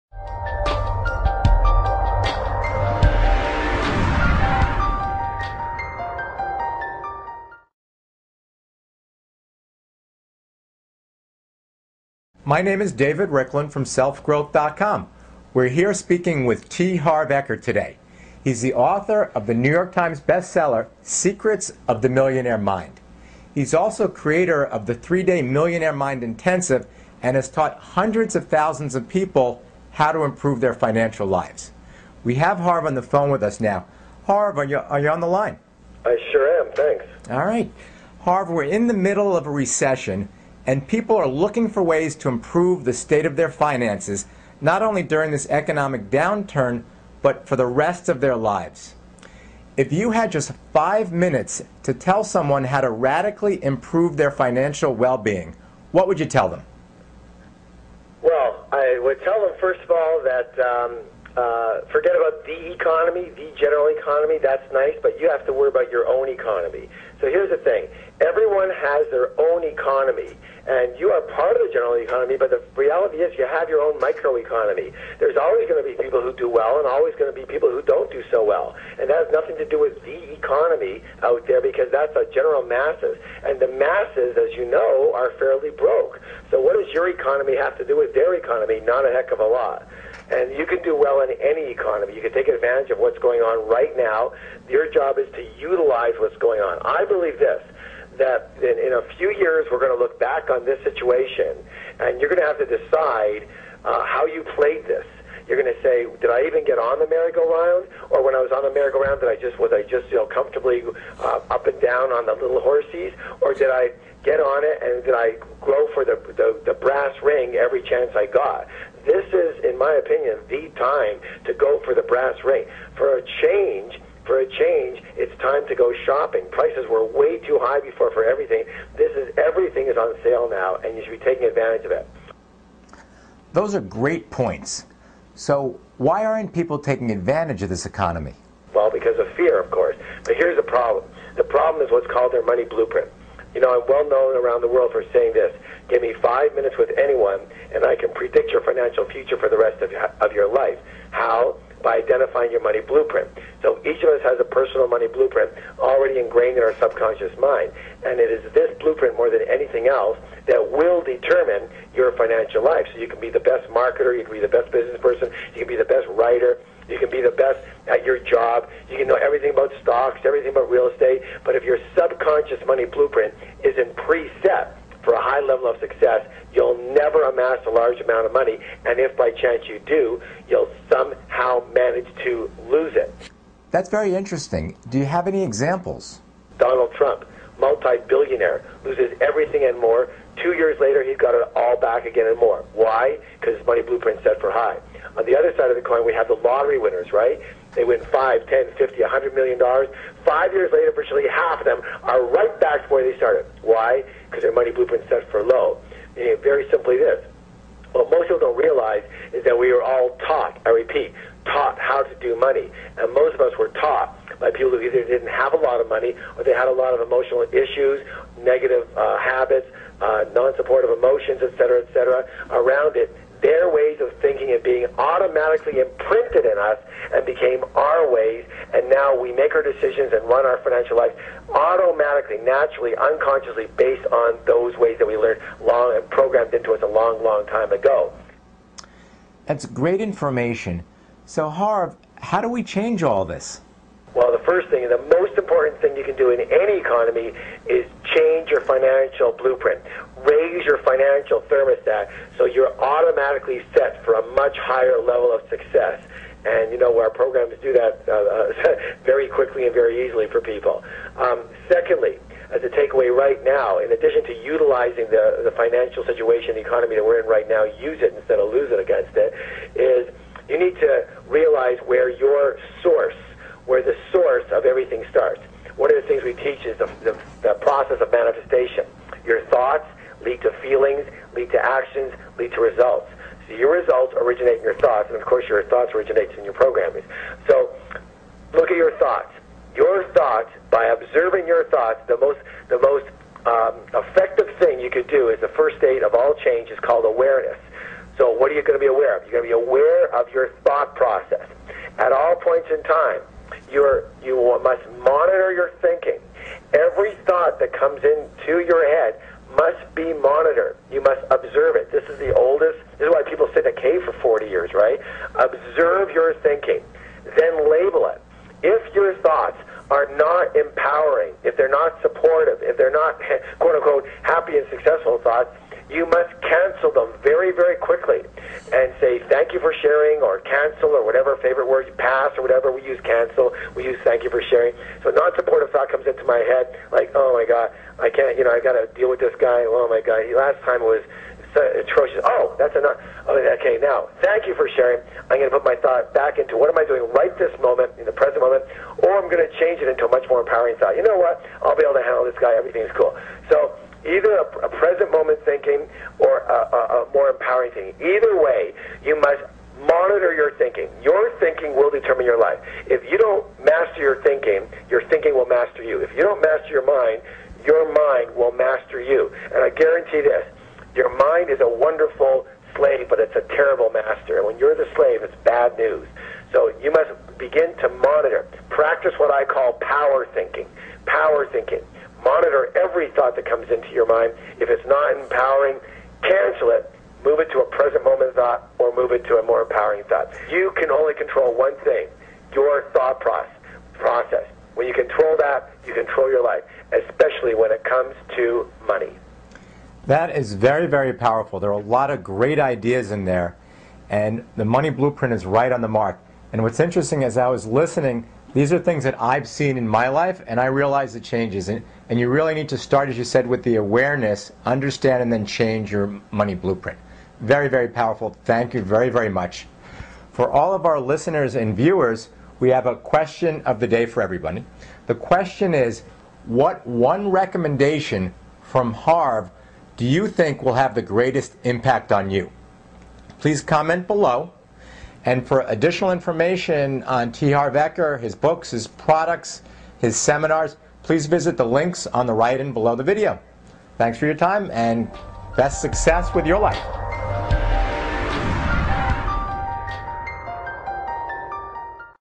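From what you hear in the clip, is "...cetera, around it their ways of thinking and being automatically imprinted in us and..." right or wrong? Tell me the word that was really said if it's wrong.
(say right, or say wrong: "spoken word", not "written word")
right.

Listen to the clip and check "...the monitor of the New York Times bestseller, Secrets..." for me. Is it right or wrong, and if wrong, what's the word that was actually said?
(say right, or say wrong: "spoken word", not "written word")
wrong: "author", not "monitor".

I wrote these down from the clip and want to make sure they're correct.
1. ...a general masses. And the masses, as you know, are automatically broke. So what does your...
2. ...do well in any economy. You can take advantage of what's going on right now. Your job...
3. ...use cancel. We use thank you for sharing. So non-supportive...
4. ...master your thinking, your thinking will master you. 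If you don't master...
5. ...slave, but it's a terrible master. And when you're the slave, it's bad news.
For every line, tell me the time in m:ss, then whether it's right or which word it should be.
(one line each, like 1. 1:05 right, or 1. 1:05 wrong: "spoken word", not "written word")
1. 1:22 wrong: "fairly", not "automatically"
2. 1:30 right
3. 5:32 right
4. 6:03 right
5. 6:12 right.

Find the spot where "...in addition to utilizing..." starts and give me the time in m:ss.
4:23.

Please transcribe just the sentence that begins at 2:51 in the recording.
But if your subconscious money blueprint isn't preset, for a high level of success, you'll never amass a large amount of money.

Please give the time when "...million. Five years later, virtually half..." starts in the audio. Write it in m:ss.
3:19.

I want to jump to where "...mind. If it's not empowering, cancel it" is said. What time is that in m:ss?
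6:24.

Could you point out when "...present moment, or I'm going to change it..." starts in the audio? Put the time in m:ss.
5:48.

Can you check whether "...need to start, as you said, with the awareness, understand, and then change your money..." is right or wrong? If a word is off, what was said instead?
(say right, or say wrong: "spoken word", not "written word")
right.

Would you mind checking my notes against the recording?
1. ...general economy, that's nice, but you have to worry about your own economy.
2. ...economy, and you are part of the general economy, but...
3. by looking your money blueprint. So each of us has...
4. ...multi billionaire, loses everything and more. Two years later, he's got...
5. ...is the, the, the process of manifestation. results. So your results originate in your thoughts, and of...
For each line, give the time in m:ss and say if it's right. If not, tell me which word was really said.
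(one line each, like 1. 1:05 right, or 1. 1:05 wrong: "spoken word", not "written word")
1. 1:03 right
2. 1:09 right
3. 2:31 wrong: "identifying", not "looking"
4. 3:07 right
5. 4:36 right.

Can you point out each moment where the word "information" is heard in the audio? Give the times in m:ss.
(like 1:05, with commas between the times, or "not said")
4:00, 7:16.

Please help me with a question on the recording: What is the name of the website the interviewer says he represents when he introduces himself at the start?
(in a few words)
selfgrowth.com.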